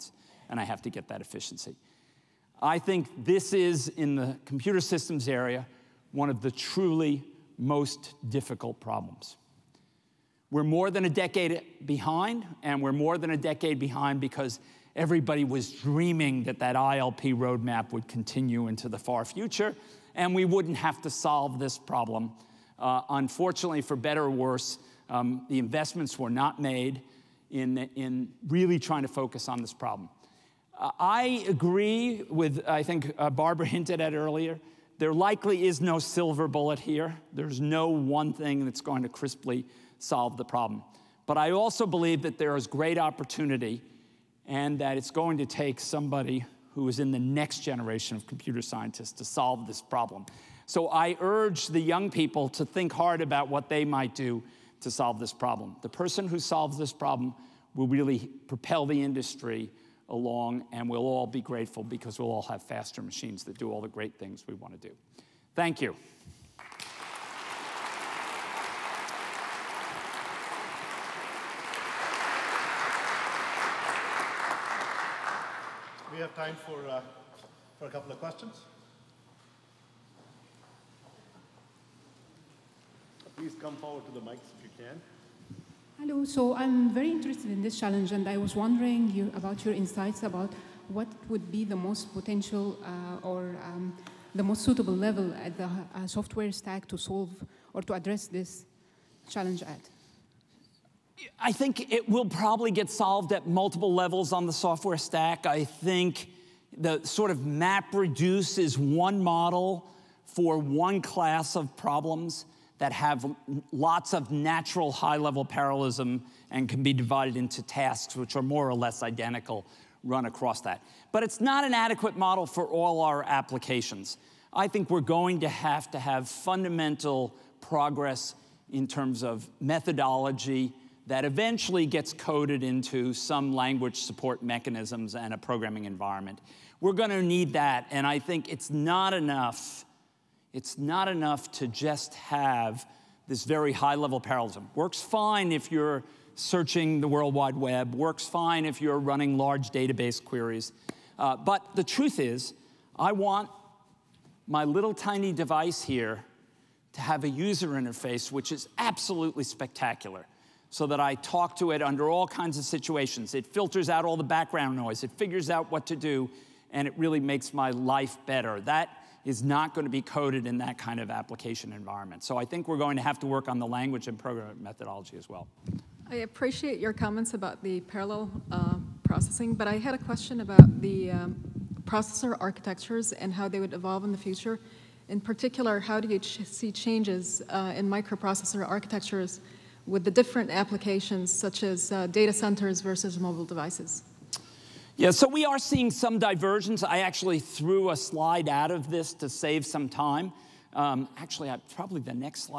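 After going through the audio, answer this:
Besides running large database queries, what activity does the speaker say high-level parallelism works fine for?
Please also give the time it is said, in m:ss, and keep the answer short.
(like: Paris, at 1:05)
searching the World Wide Web, at 2:26.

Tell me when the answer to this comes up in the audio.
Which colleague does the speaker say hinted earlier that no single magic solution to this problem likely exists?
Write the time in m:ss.
0:33.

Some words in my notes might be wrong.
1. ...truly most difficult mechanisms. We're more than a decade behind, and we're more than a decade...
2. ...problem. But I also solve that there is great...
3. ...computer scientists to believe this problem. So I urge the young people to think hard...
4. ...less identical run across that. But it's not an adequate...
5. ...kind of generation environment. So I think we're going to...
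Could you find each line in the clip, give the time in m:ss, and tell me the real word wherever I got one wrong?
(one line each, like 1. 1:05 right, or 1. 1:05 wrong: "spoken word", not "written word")
1. 0:06 wrong: "problems", not "mechanisms"
2. 0:40 wrong: "believe", not "solve"
3. 0:48 wrong: "solve", not "believe"
4. 1:58 right
5. 2:50 wrong: "application", not "generation".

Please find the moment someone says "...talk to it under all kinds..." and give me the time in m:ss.
2:41.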